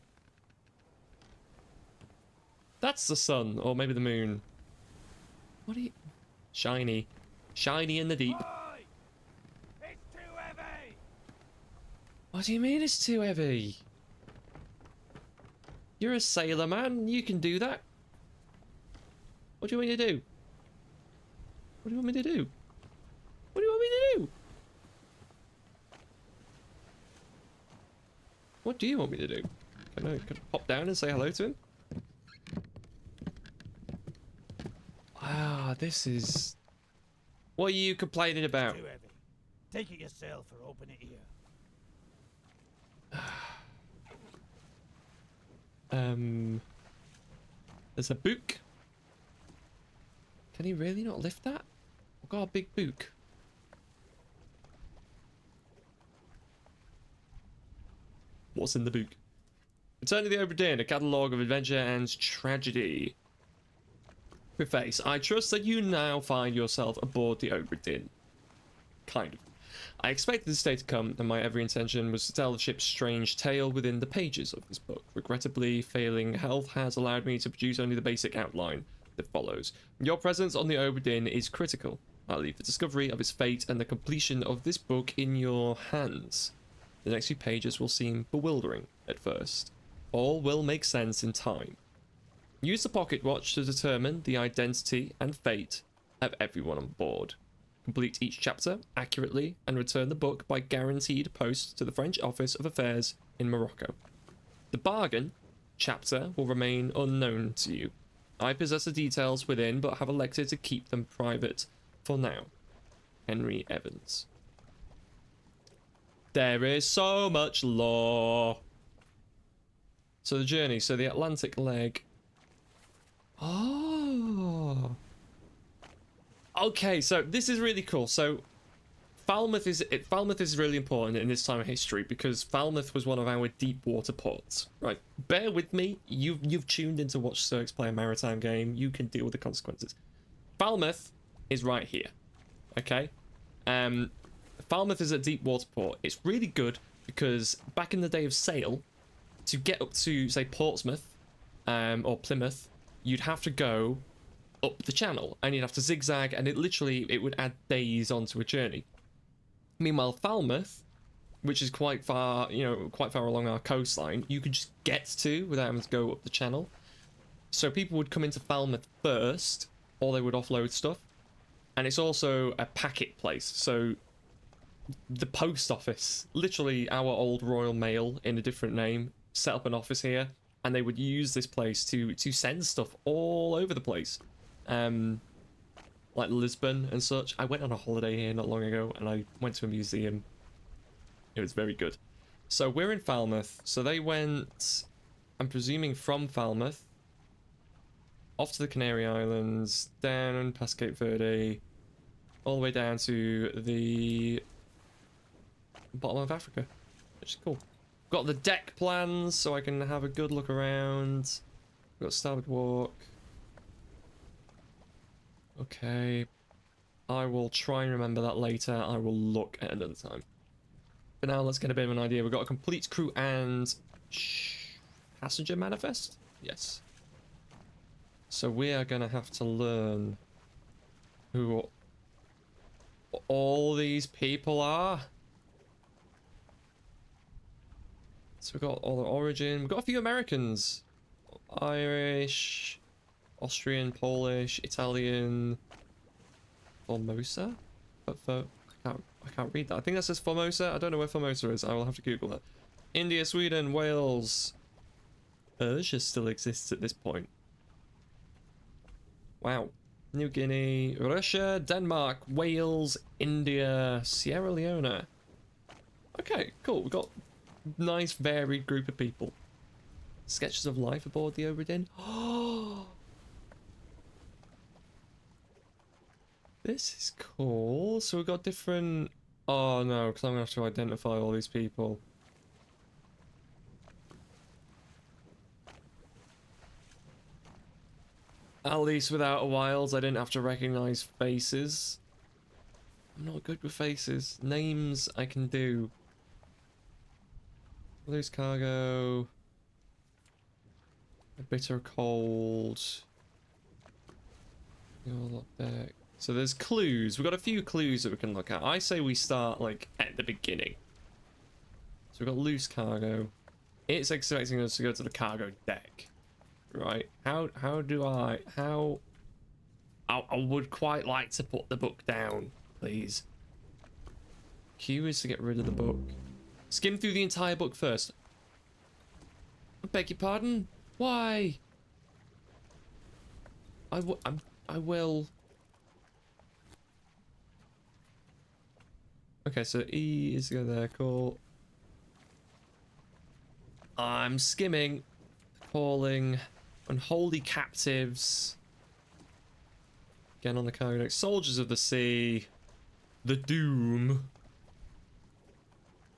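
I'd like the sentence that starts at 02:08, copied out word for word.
So Falmouth is it, Falmouth is really important in this time of history because Falmouth was one of our deep water ports.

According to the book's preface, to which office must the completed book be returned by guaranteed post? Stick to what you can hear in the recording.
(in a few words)
French Office of Affairs in Morocco.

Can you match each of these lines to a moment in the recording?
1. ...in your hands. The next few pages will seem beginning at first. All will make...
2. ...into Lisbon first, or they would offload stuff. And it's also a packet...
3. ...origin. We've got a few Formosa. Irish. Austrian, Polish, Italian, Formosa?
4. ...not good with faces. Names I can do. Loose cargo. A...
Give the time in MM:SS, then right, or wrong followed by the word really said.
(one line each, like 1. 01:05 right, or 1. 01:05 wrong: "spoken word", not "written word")
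1. 01:25 wrong: "bewildering", not "beginning"
2. 02:48 wrong: "Falmouth", not "Lisbon"
3. 03:59 wrong: "Americans", not "Formosa"
4. 04:53 right.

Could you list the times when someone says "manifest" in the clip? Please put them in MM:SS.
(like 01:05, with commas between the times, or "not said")
03:45.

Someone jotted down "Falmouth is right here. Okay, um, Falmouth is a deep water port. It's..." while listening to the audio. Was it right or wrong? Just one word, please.
right.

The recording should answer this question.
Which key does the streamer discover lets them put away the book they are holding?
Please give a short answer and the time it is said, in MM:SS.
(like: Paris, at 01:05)
Q, at 05:24.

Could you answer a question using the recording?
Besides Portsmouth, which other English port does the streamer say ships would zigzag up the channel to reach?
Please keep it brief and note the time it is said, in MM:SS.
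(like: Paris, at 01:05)
Plymouth, at 02:32.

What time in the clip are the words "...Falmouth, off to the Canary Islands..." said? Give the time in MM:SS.
03:16.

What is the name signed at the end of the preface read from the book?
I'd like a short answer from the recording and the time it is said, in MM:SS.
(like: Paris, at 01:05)
Henry Evans, at 01:53.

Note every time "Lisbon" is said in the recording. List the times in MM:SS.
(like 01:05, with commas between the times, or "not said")
03:06.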